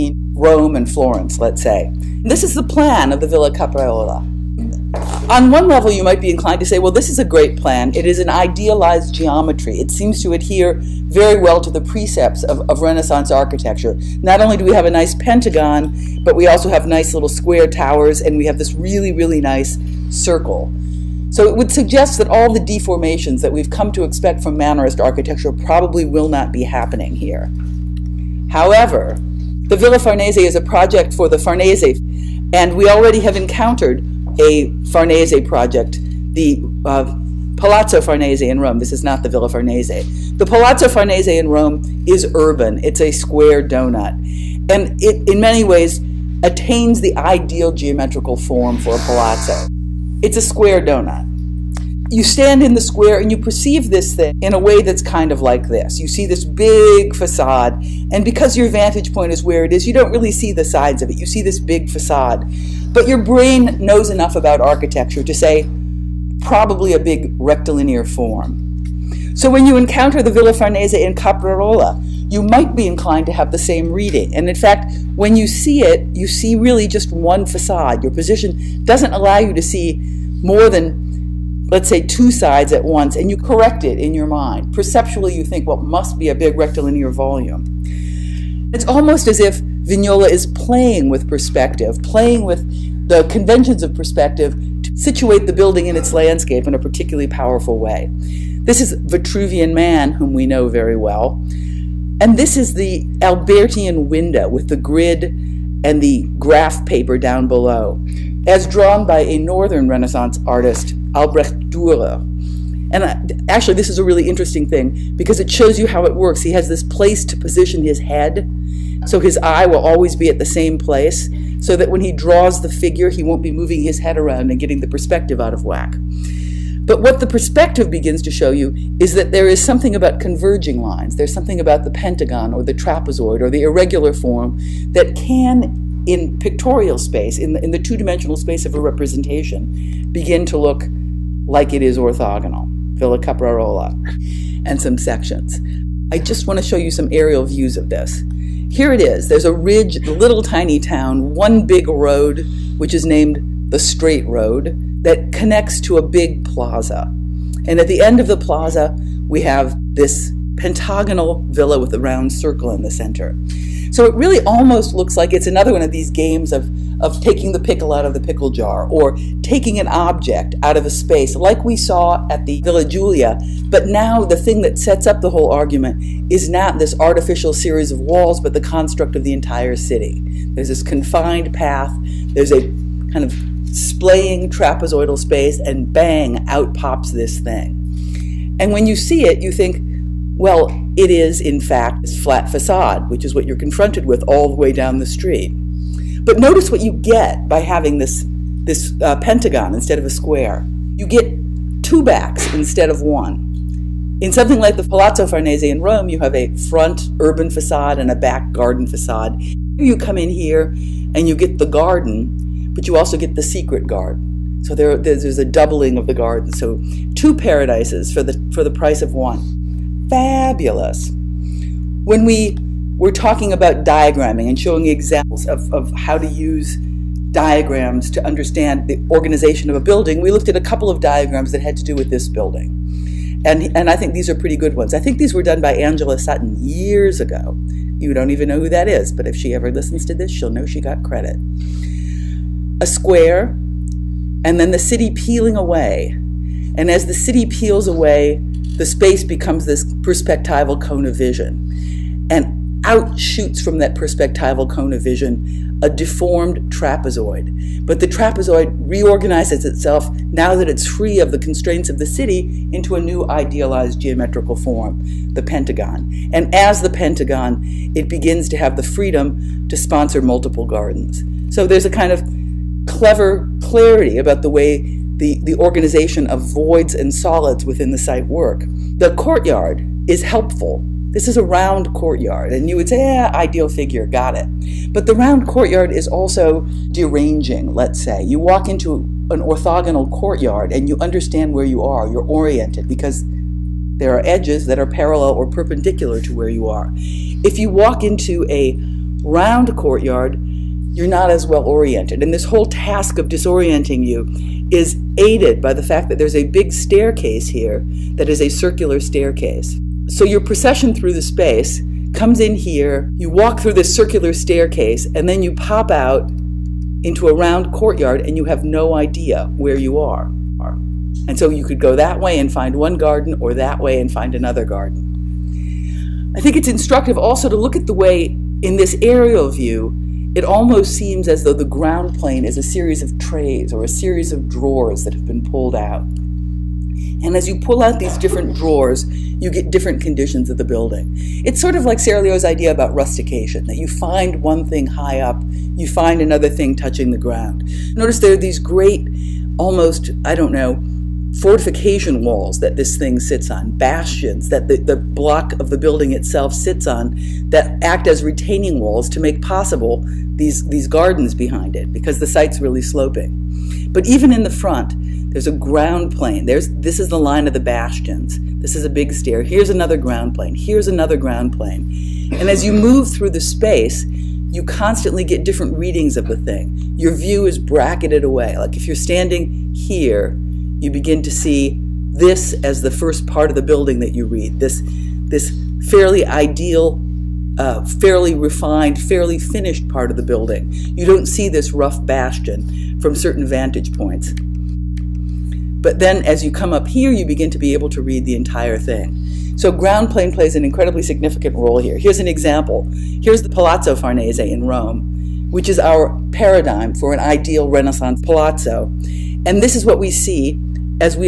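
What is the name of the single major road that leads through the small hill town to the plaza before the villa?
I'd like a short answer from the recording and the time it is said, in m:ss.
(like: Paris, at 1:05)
The Straight Road, at 2:33.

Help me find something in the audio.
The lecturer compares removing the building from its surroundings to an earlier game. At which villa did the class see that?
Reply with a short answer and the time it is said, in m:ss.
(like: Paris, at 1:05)
Villa Giulia, at 2:52.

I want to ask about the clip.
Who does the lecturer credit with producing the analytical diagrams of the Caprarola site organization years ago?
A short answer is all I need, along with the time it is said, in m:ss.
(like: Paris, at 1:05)
Angela Sutton, at 3:55.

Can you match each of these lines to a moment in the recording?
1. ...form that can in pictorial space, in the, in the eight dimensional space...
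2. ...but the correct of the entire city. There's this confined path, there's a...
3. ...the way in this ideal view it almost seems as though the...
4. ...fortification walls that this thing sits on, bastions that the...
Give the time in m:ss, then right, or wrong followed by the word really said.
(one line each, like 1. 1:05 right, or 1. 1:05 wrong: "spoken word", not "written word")
1. 2:14 wrong: "two", not "eight"
2. 2:58 wrong: "construct", not "correct"
3. 5:27 wrong: "aerial", not "ideal"
4. 5:51 right.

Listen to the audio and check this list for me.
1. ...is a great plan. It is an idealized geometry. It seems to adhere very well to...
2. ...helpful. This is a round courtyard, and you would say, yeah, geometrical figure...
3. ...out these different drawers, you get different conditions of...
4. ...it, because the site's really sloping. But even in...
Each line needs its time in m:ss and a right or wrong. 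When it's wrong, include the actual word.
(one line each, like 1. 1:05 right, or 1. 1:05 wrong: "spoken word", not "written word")
1. 0:07 right
2. 4:40 wrong: "ideal", not "geometrical"
3. 5:37 right
4. 6:01 right.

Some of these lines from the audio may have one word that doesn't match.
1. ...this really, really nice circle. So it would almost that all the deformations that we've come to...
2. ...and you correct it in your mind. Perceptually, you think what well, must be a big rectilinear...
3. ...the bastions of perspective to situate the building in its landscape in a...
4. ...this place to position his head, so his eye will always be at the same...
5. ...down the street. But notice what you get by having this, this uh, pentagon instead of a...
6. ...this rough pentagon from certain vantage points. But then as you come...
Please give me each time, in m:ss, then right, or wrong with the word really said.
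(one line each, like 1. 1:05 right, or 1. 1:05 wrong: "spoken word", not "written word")
1. 0:18 wrong: "suggest", not "almost"
2. 1:23 right
3. 1:33 wrong: "conventions", not "bastions"
4. 1:56 right
5. 3:14 right
6. 6:31 wrong: "bastion", not "pentagon".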